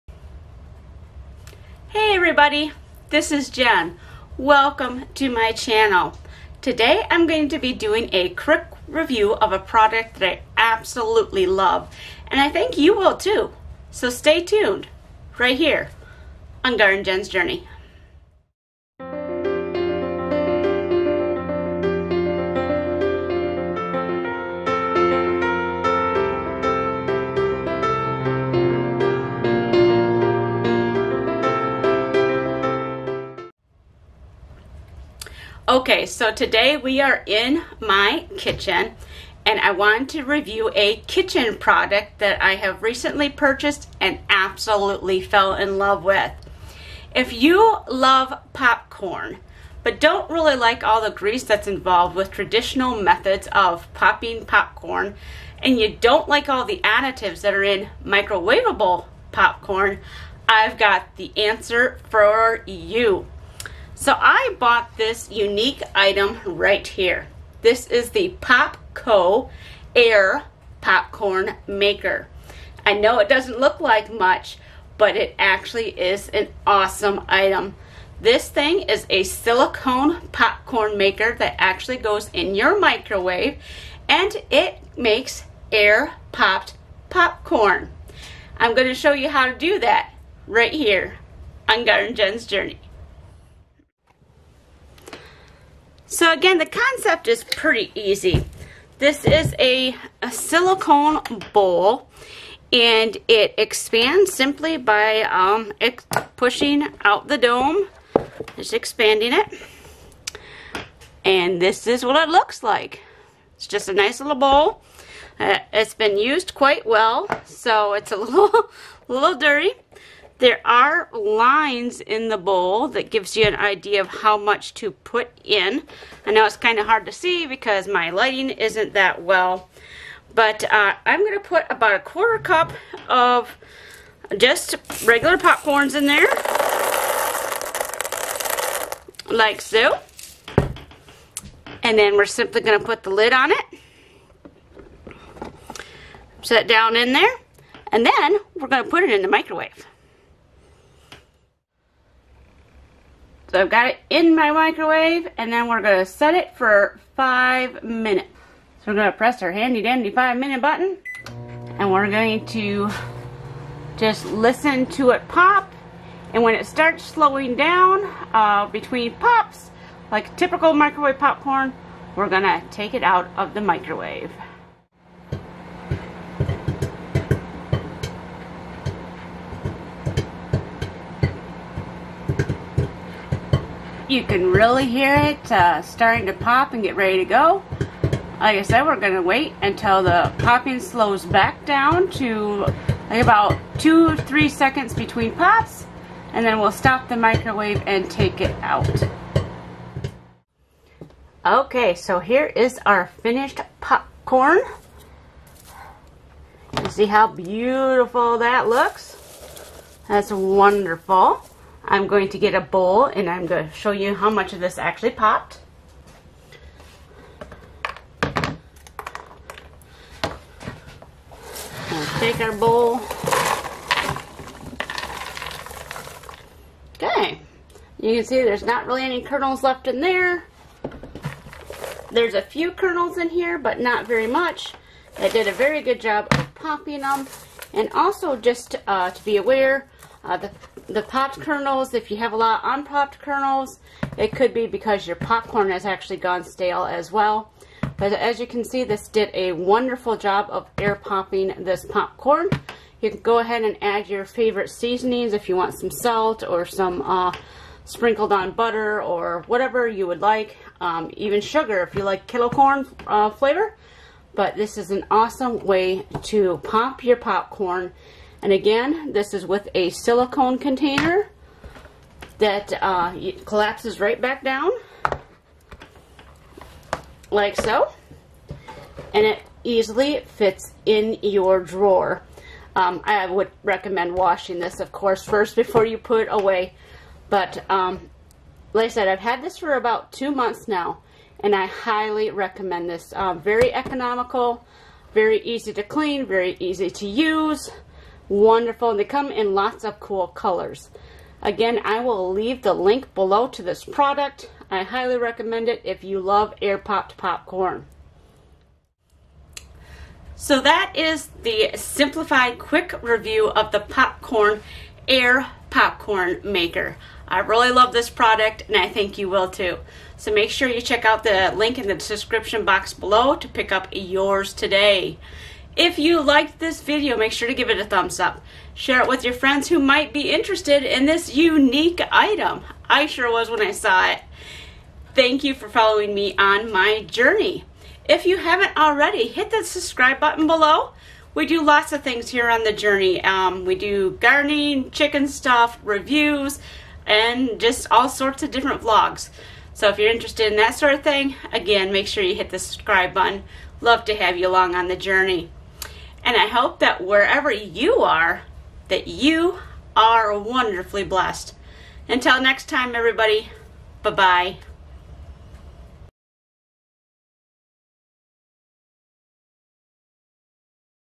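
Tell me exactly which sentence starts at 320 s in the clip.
So make sure you check out the link in the description box below to pick up yours today.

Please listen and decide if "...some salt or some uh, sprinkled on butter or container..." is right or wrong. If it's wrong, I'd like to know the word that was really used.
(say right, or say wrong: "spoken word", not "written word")
wrong: "whatever", not "container".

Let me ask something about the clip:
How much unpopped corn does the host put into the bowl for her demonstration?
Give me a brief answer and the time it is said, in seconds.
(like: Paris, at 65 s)
A quarter cup, at 131 s.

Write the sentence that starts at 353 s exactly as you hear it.
Love to have you along on the journey.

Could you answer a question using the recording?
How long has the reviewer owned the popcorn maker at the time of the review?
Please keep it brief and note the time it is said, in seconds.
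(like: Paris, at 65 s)
2 months, at 290 s.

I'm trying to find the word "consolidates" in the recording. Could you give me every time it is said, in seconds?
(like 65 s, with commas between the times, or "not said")
not said.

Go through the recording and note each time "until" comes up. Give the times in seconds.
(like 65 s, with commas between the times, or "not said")
189 s, 362 s.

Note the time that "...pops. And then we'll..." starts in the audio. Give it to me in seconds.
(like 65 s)
195 s.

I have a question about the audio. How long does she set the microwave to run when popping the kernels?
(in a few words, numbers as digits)
5 minutes.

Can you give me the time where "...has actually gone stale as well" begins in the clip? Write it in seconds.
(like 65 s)
245 s.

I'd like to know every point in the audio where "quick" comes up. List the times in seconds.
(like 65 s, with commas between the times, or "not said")
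8 s, 312 s.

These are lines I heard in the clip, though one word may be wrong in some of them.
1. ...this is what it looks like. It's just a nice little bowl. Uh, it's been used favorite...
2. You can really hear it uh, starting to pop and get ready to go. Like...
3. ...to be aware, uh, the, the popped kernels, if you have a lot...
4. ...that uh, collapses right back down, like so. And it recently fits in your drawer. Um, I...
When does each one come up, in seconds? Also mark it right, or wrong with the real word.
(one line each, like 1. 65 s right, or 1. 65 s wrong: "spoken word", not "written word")
1. 111 s wrong: "quite", not "favorite"
2. 184 s right
3. 239 s right
4. 272 s wrong: "easily", not "recently".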